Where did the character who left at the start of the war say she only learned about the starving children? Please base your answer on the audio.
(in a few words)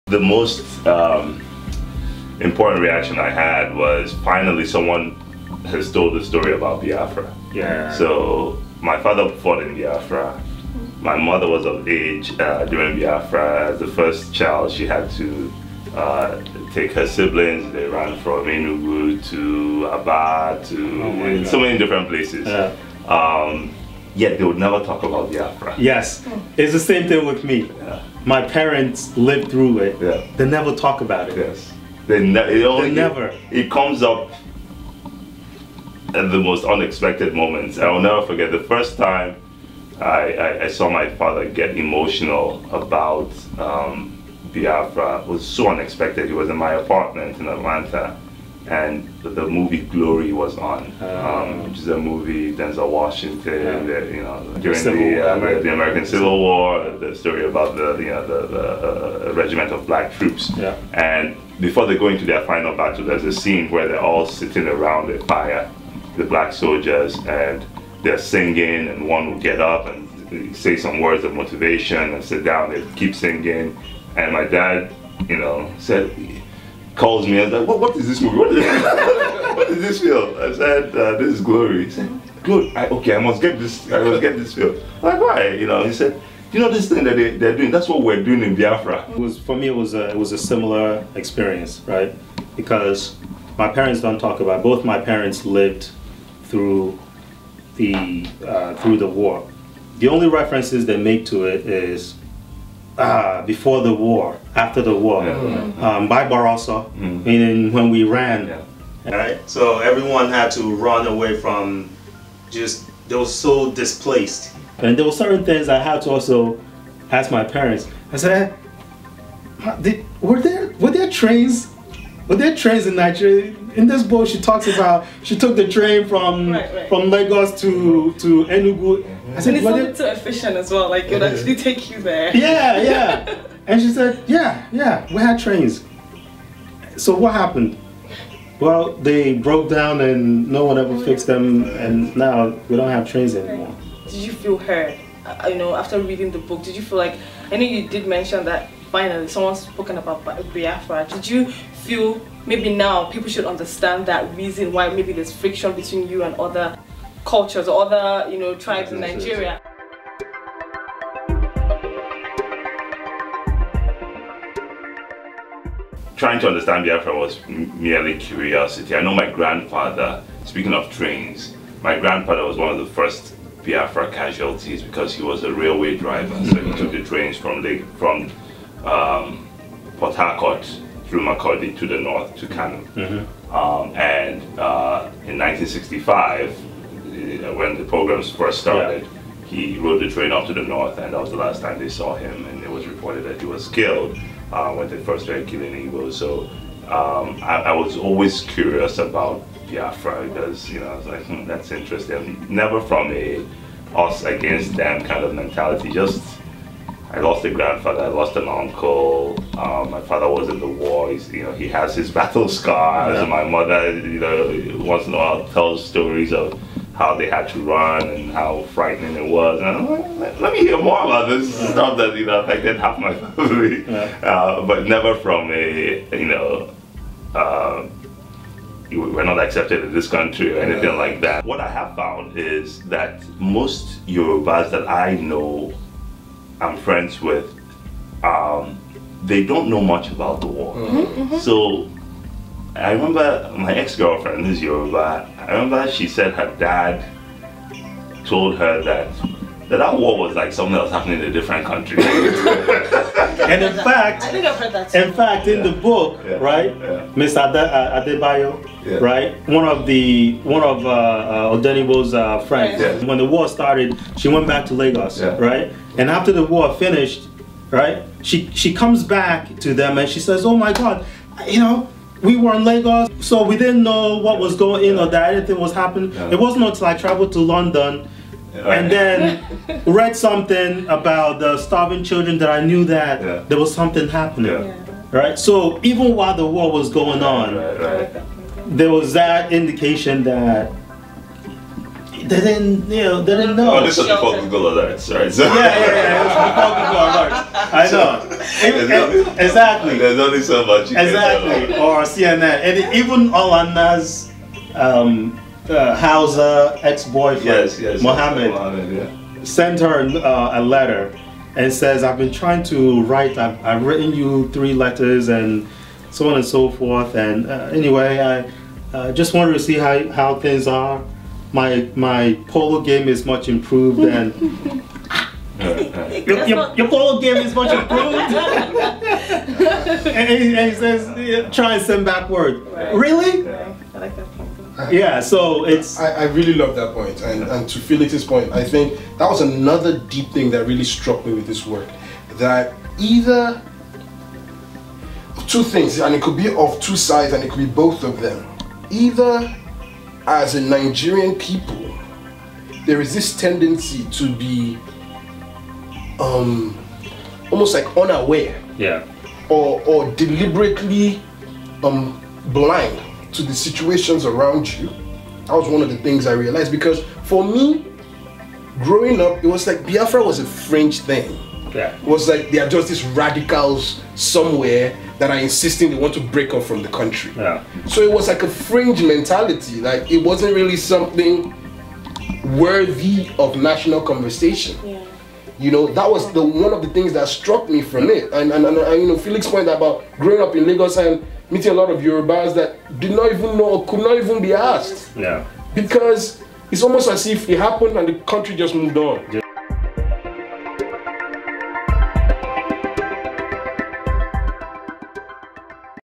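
London.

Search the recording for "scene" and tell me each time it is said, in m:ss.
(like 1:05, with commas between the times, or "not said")
1:03.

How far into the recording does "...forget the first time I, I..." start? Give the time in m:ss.
0:38.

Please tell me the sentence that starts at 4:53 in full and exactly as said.
Oh, this was before Google Alerts, right?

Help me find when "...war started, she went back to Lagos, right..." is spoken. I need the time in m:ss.
4:23.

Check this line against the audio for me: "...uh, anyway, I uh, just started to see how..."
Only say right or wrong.
wrong.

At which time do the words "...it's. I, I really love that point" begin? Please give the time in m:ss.
5:35.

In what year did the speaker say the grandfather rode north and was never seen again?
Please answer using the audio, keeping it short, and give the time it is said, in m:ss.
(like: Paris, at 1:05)
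1965, at 3:05.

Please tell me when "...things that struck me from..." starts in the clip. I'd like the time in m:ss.
6:26.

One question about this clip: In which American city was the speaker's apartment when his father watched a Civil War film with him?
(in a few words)
Atlanta.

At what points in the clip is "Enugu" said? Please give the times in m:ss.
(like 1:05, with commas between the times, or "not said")
0:18, 2:08.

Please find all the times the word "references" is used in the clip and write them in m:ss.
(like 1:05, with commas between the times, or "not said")
1:40.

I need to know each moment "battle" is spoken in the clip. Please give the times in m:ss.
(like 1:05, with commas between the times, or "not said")
1:02, 3:32.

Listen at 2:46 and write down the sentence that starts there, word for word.
Trying to understand Biafra was merely curiosity.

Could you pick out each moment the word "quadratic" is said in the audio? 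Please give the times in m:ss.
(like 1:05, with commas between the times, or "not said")
not said.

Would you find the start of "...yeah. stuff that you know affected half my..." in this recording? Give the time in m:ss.
3:41.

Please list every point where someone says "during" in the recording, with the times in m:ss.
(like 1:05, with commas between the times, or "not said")
0:12, 0:54.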